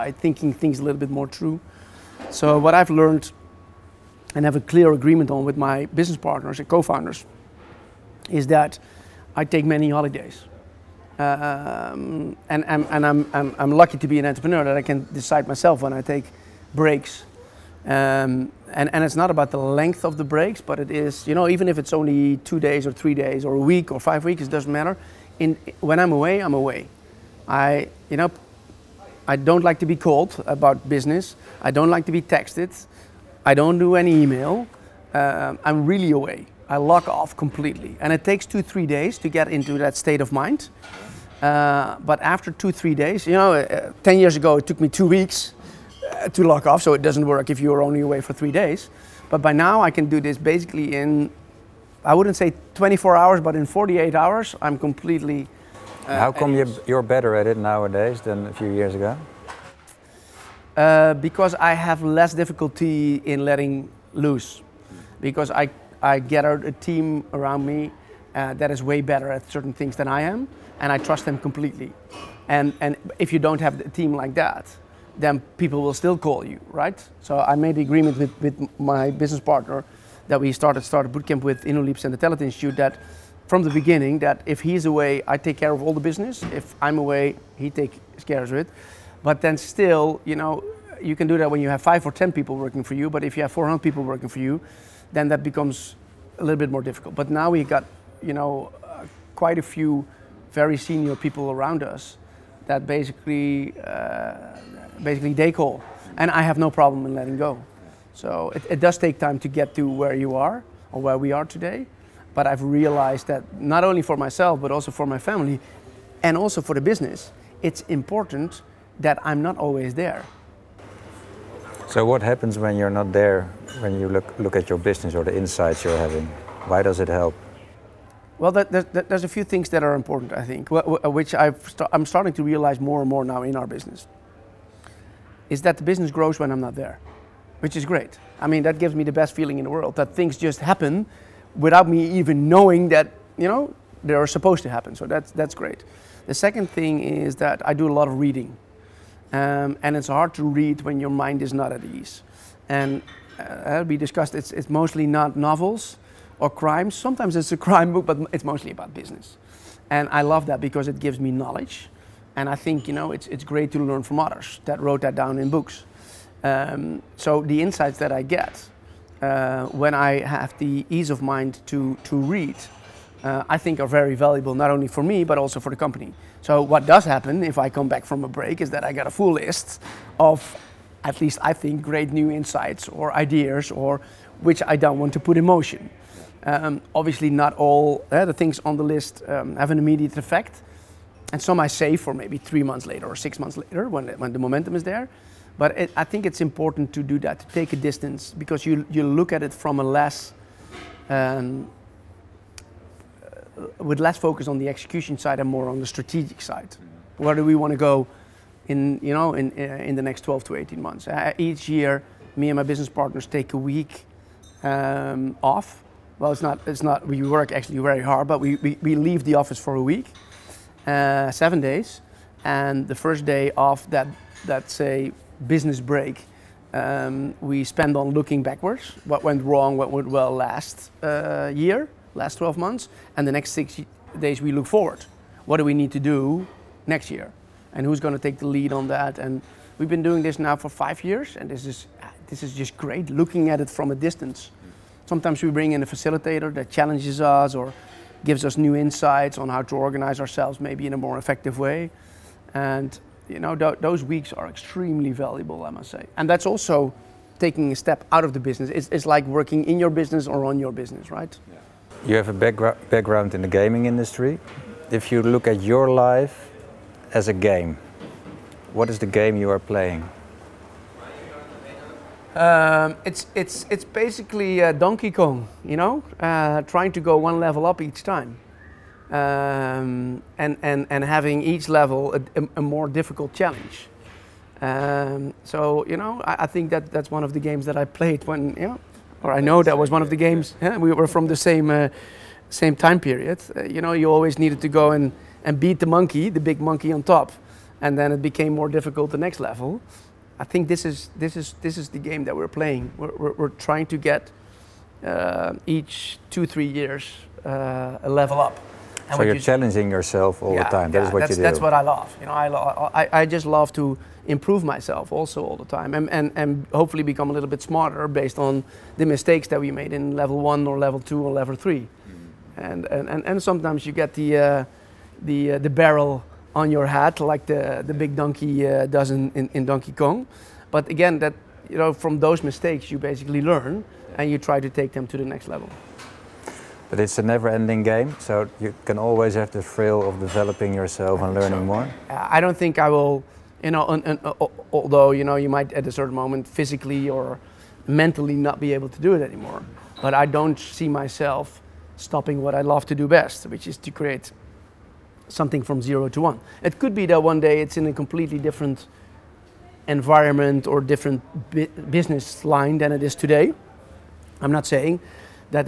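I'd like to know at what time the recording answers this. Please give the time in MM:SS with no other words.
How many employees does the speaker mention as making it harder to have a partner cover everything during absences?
01:33.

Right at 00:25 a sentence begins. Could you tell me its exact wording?
In, when I'm away, I'm away.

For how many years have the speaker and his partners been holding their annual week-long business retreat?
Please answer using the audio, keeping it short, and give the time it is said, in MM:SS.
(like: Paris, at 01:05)
5 years, at 04:00.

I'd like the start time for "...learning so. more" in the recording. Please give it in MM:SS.
05:41.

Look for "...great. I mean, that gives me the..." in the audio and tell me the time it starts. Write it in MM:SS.
02:17.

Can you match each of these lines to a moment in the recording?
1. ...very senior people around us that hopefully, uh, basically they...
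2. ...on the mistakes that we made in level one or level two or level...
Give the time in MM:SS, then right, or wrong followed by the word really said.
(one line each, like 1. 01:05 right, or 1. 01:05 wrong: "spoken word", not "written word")
1. 01:40 wrong: "basically", not "hopefully"
2. 05:18 right.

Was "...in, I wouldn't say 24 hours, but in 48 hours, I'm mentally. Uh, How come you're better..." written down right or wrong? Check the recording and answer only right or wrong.
wrong.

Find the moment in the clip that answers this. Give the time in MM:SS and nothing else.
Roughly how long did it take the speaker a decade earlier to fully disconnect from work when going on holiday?
00:44.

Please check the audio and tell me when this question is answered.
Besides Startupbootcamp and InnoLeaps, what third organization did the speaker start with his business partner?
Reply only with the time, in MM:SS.
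01:22.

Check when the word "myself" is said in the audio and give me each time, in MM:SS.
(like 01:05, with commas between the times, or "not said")
00:15, 01:54, 05:14, 05:50.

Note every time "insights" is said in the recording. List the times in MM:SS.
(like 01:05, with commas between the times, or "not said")
02:05, 02:47, 03:02, 04:08.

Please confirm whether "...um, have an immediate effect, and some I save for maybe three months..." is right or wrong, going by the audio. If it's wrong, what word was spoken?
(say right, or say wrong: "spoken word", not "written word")
right.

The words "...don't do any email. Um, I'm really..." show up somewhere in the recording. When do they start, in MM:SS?
00:33.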